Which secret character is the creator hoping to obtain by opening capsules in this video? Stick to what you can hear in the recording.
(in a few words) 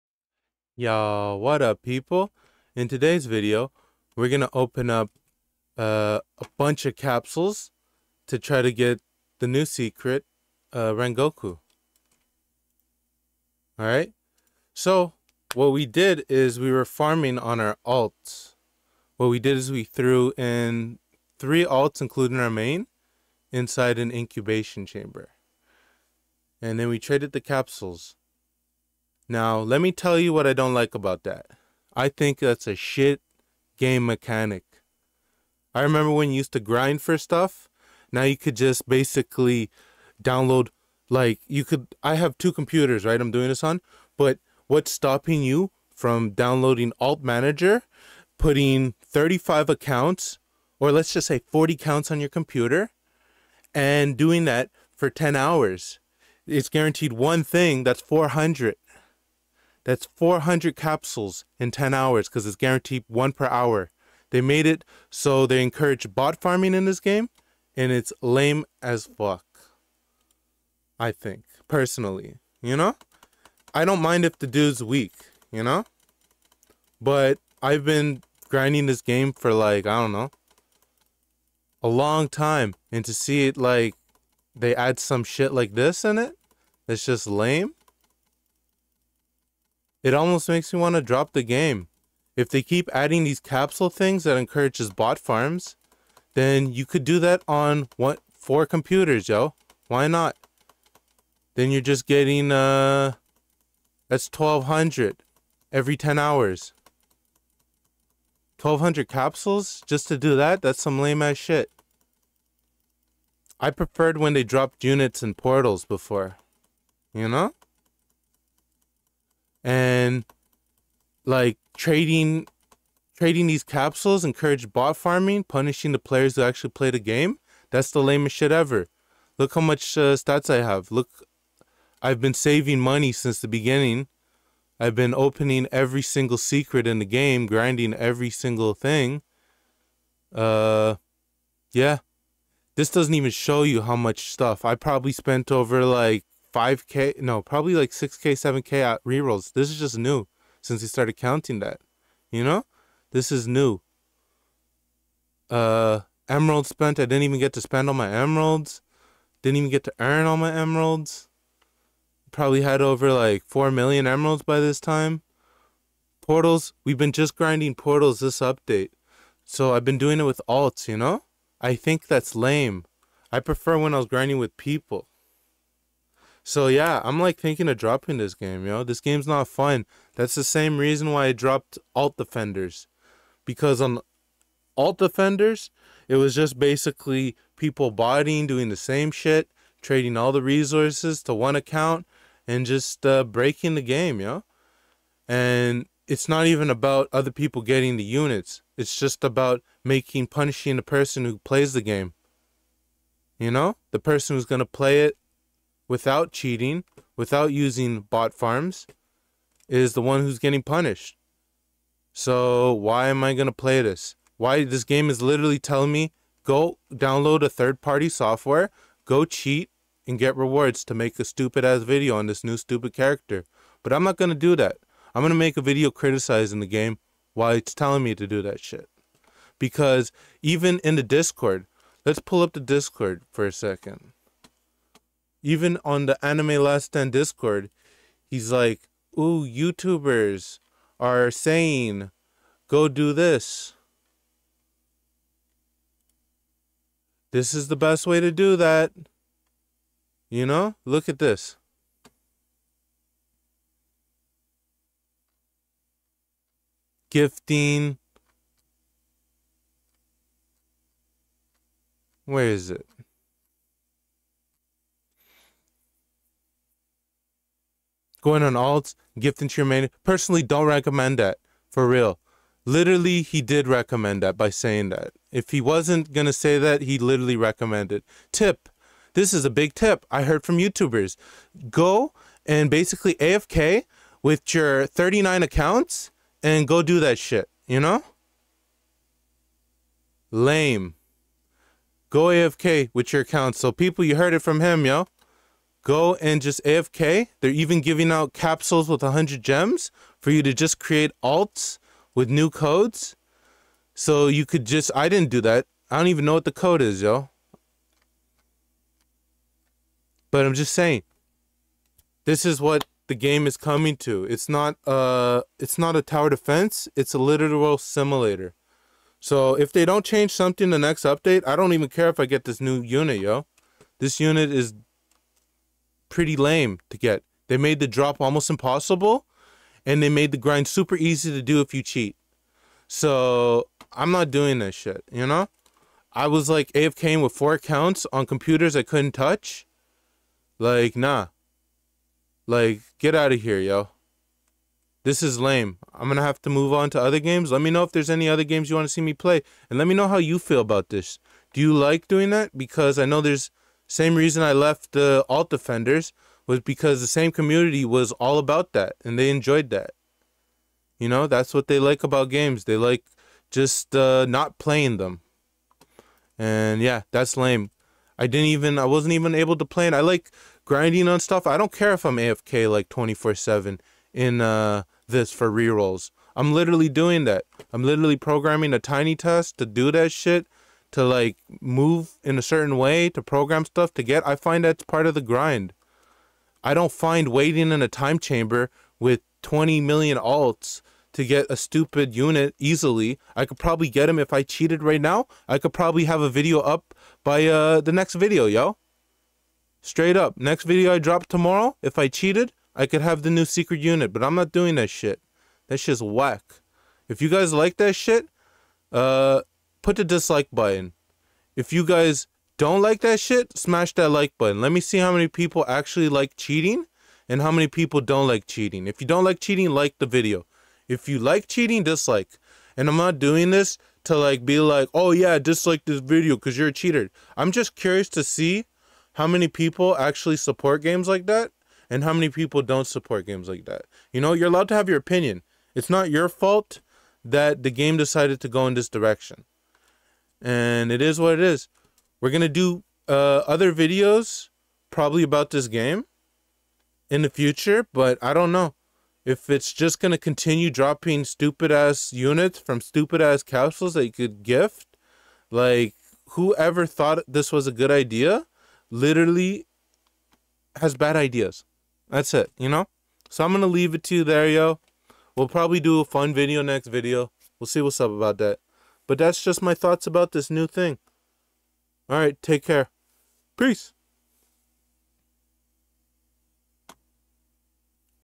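Rengoku.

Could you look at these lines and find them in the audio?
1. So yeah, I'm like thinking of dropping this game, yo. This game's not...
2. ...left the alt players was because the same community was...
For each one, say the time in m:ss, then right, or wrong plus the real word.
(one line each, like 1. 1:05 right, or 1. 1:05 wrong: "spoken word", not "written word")
1. 2:56 right
2. 5:54 wrong: "defenders", not "players".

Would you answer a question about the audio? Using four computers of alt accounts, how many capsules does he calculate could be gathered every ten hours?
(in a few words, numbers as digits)
1200.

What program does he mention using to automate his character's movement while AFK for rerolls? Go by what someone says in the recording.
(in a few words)
TinyTask.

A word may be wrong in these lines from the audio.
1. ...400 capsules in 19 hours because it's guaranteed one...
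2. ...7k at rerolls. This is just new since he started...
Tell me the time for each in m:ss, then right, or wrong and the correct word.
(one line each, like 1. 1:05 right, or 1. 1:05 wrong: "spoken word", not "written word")
1. 1:00 wrong: "10", not "19"
2. 2:28 right.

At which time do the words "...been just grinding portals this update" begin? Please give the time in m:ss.
2:46.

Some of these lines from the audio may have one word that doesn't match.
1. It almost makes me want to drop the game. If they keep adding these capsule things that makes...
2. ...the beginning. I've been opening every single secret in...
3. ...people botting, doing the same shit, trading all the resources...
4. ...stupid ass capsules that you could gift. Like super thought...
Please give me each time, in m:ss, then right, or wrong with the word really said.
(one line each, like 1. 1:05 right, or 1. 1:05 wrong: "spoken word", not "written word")
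1. 1:30 wrong: "encourages", not "makes"
2. 2:13 right
3. 3:07 right
4. 7:32 wrong: "whoever", not "super".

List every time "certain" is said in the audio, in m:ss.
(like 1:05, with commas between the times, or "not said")
6:22.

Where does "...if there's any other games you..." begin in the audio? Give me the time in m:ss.
5:47.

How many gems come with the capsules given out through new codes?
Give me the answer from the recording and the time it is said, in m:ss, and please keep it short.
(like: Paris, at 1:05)
100 gems, at 4:59.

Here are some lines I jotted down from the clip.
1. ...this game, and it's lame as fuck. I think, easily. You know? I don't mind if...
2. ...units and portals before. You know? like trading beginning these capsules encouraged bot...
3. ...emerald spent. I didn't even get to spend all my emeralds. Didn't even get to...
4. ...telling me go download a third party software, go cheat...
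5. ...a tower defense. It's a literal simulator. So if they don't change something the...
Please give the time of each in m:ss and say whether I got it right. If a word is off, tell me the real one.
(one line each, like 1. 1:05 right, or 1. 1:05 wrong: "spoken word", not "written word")
1. 1:06 wrong: "personally", not "easily"
2. 1:54 wrong: "trading", not "beginning"
3. 2:36 right
4. 3:35 right
5. 5:15 right.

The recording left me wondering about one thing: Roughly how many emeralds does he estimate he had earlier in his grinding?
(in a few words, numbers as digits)
4 million.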